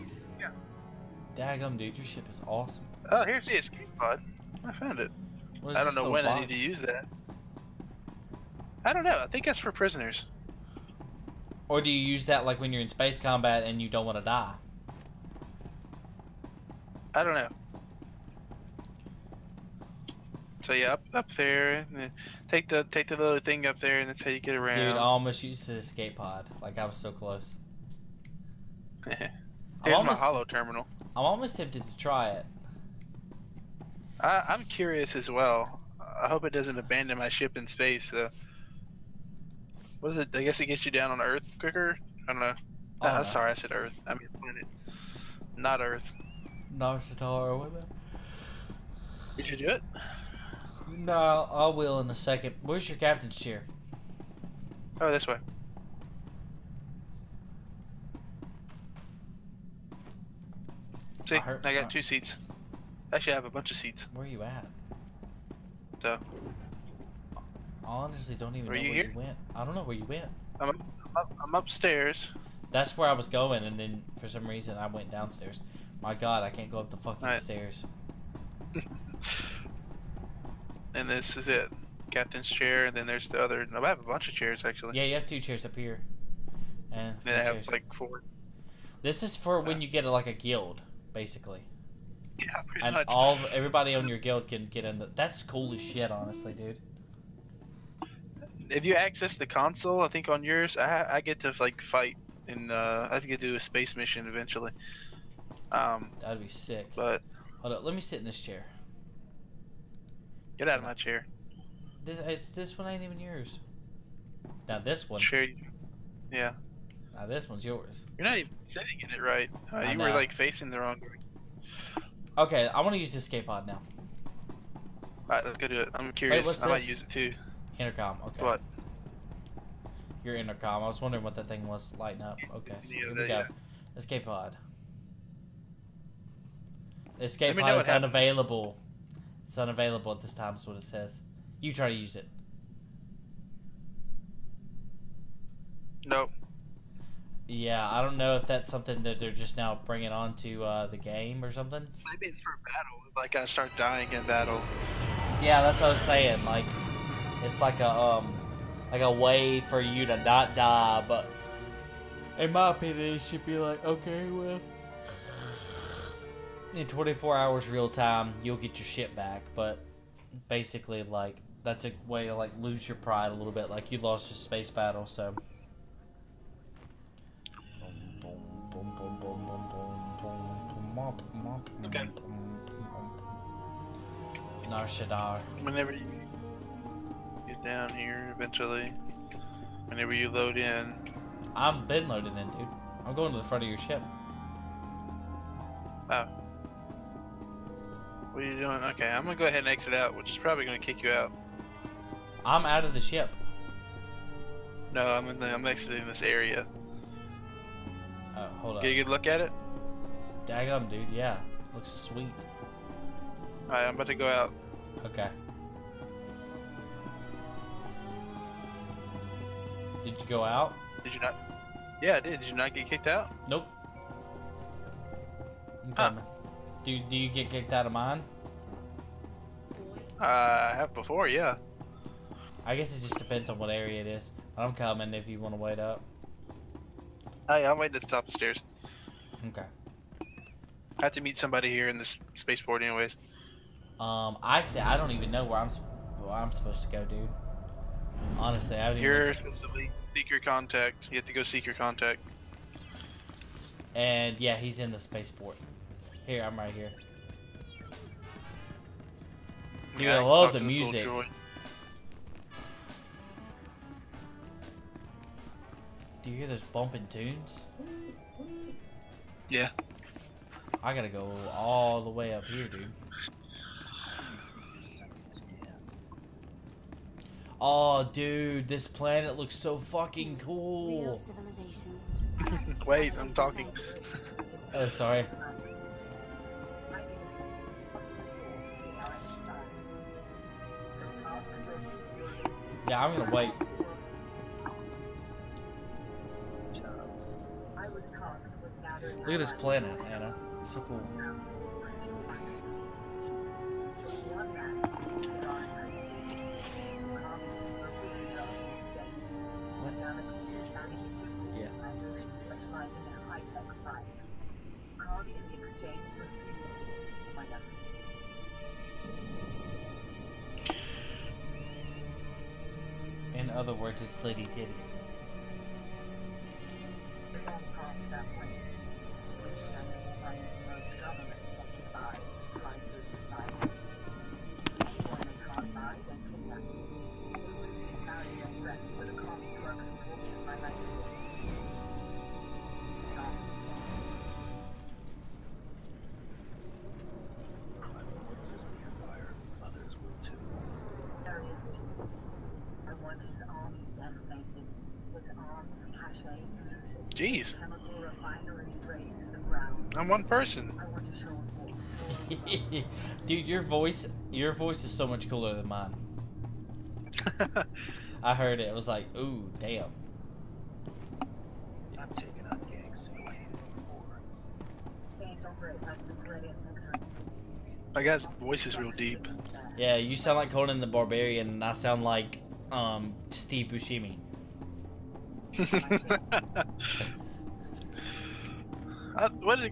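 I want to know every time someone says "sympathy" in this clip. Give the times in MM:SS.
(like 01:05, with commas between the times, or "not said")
not said.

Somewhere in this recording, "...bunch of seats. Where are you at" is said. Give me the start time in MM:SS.
01:03.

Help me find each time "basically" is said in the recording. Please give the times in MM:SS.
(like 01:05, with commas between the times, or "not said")
01:31, 02:50.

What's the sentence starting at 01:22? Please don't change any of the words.
Captain's chair, and then there's the other.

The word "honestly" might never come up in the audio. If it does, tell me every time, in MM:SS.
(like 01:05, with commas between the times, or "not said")
01:07, 01:36, 04:08.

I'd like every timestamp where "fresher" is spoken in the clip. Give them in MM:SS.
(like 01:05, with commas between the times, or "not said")
not said.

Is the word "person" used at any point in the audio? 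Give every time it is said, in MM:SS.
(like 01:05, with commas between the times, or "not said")
06:00.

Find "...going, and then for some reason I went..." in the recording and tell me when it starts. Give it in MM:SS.
01:13.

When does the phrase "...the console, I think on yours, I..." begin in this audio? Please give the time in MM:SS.
01:39.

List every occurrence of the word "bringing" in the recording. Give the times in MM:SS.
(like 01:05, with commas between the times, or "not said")
02:29.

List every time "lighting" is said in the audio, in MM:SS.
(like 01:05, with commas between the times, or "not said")
02:11.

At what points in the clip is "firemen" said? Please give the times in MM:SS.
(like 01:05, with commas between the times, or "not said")
not said.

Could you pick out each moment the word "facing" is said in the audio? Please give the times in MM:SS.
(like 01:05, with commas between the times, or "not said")
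02:00.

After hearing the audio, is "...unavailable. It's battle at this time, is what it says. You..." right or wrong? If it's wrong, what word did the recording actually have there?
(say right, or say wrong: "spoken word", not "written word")
wrong: "unavailable", not "battle".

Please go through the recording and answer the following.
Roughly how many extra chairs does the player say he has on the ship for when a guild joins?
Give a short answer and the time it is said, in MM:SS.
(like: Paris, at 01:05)
4, at 01:27.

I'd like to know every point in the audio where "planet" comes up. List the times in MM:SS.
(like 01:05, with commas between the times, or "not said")
00:44, 04:38.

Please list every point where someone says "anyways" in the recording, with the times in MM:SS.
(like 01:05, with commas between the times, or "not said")
04:02.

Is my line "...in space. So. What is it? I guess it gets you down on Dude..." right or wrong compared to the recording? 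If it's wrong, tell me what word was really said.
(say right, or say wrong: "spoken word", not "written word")
wrong: "Earth", not "Dude".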